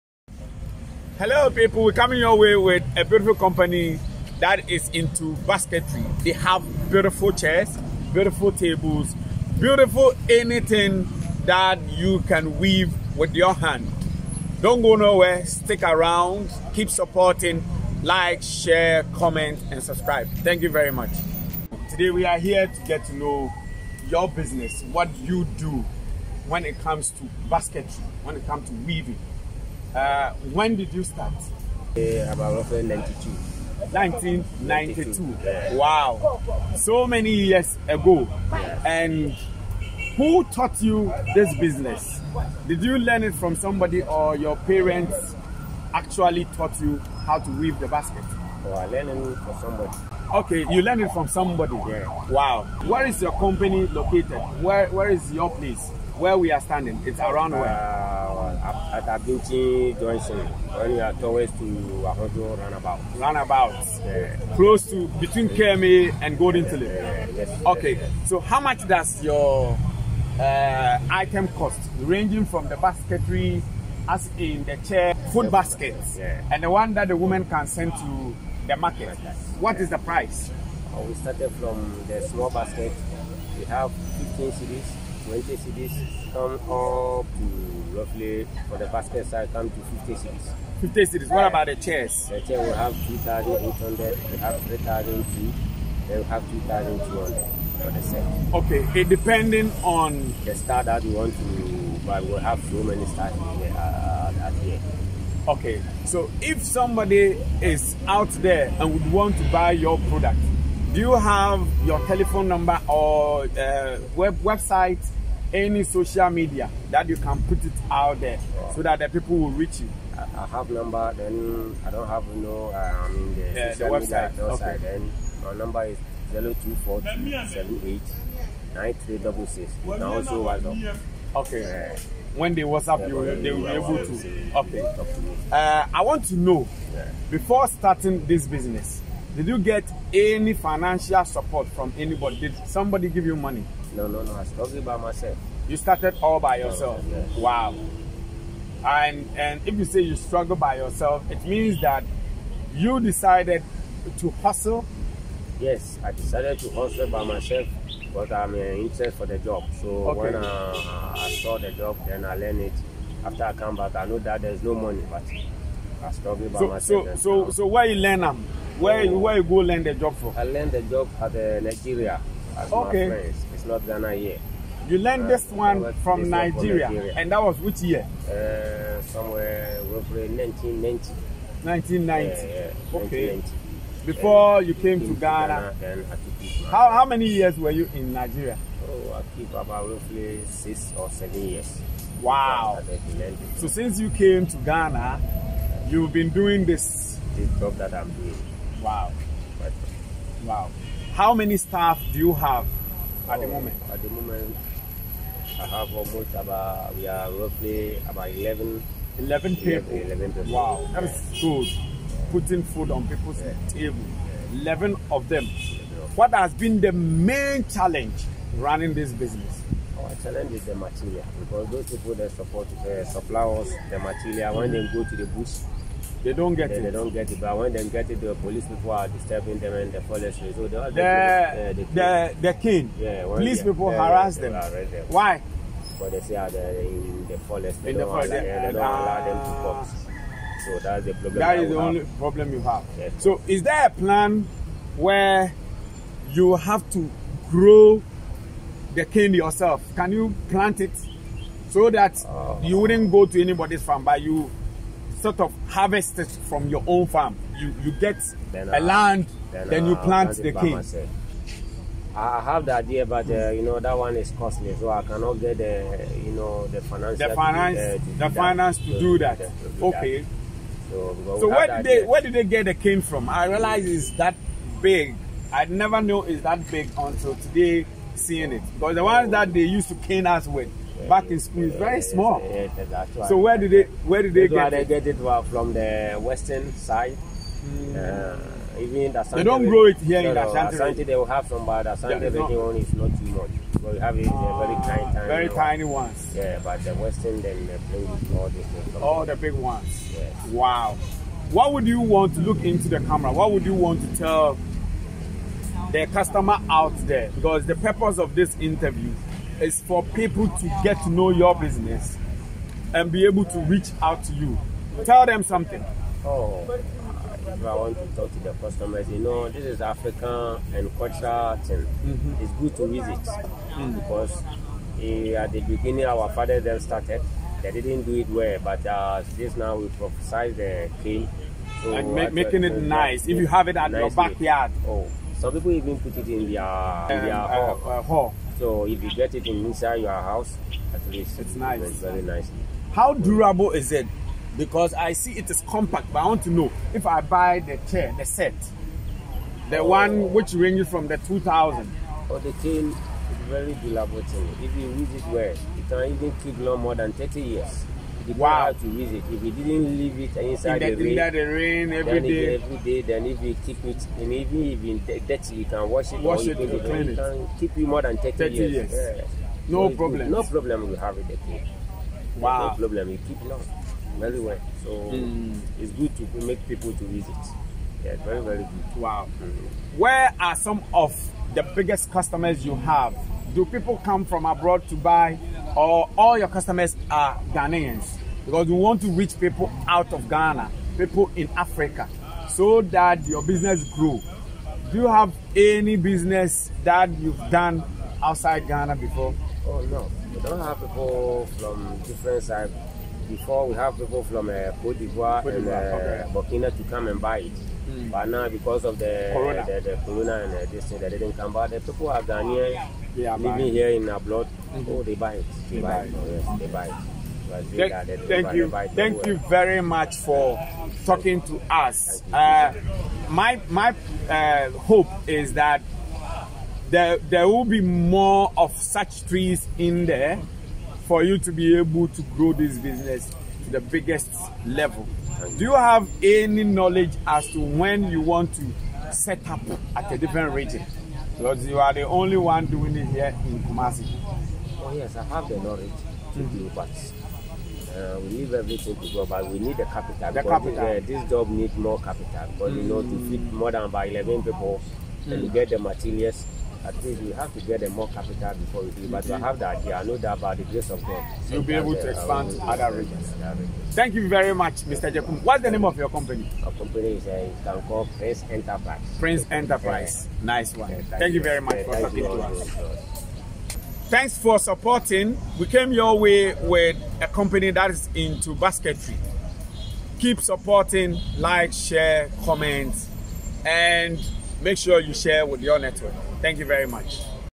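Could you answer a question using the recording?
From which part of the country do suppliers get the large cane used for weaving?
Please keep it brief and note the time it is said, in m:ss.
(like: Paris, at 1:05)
The western side, at 4:46.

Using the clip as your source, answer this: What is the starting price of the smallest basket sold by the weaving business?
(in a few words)
15 cedis.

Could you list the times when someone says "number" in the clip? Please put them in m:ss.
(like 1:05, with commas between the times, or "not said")
1:52, 2:00, 2:05.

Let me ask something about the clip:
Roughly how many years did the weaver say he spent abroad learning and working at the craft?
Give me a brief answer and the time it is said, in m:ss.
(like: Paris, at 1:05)
6 or 7 years, at 3:10.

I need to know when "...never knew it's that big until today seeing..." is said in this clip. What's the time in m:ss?
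4:35.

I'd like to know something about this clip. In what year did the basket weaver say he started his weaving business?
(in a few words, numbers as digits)
1992.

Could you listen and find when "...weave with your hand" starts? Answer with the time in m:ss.
0:12.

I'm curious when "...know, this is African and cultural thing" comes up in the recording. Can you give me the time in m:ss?
5:19.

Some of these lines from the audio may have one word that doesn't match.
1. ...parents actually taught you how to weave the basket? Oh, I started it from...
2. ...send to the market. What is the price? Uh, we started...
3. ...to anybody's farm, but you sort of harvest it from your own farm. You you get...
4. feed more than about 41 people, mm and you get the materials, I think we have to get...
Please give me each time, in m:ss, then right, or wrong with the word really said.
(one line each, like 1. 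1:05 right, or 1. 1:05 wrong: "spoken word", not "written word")
1. 0:44 wrong: "learned", not "started"
2. 1:17 right
3. 4:13 right
4. 7:33 wrong: "11", not "41".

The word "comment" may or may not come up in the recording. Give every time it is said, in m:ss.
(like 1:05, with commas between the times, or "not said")
0:19, 8:02.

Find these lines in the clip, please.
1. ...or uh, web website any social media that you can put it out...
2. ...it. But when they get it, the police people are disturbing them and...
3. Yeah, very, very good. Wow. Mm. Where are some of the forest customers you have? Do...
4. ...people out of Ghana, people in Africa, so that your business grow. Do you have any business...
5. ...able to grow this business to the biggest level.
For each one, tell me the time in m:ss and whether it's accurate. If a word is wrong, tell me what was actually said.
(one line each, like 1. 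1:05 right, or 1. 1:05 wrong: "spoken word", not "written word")
1. 1:52 right
2. 3:47 right
3. 6:18 wrong: "biggest", not "forest"
4. 6:29 right
5. 7:11 right.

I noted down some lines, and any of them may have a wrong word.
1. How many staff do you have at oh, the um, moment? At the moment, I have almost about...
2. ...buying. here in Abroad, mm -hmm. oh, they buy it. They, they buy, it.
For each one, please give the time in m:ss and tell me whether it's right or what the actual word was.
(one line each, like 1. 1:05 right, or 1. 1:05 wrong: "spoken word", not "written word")
1. 3:21 right
2. 6:53 right.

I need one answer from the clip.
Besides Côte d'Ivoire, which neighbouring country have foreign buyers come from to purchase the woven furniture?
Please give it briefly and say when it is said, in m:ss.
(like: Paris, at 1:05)
Burkina, at 6:46.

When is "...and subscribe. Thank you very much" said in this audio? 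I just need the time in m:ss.
0:19.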